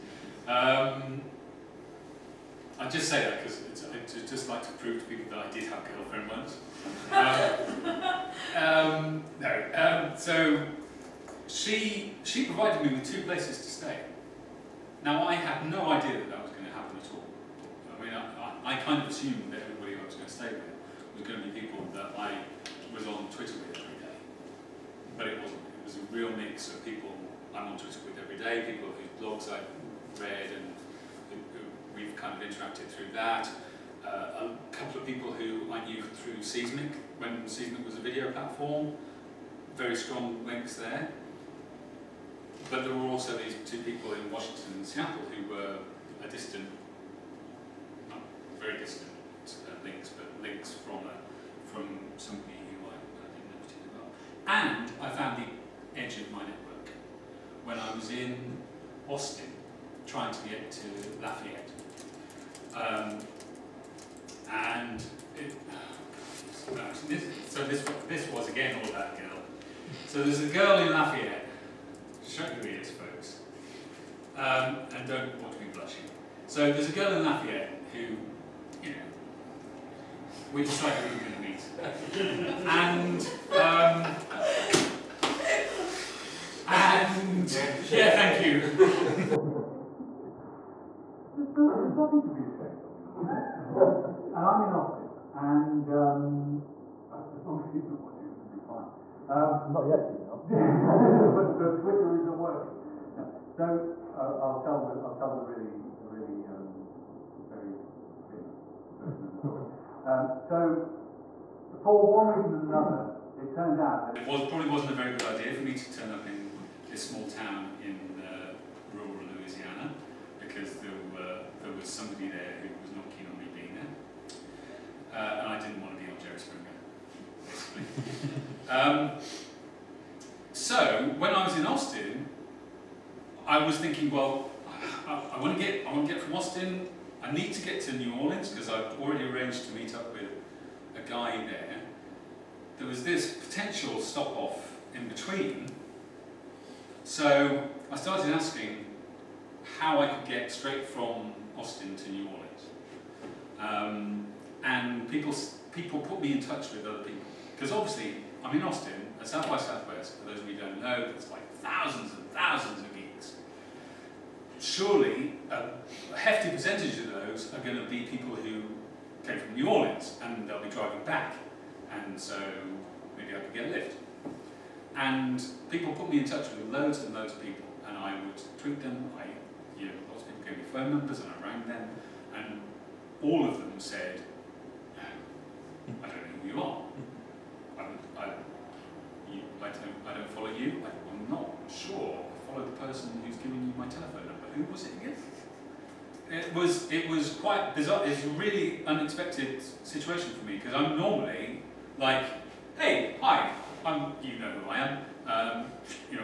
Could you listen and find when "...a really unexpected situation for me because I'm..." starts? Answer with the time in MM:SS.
03:18.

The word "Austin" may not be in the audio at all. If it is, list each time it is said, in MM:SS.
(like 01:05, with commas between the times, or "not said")
00:59, 01:34, 02:11, 02:16, 02:31, 02:38.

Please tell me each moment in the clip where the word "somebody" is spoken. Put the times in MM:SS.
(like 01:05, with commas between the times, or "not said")
00:52, 02:01.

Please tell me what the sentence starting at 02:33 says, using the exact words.
Um, and people, people put me in touch with other people.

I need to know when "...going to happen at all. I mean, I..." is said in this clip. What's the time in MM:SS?
00:16.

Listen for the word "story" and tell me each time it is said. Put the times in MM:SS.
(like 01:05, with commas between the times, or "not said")
01:49.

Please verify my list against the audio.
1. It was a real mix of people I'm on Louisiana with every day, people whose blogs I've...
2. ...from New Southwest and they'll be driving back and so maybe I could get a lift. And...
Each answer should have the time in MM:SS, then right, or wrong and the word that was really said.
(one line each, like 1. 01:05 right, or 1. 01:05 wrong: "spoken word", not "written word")
1. 00:25 wrong: "Twitter", not "Louisiana"
2. 02:49 wrong: "Orleans", not "Southwest".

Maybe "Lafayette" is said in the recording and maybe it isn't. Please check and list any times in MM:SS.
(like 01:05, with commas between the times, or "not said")
01:01, 01:10, 01:17.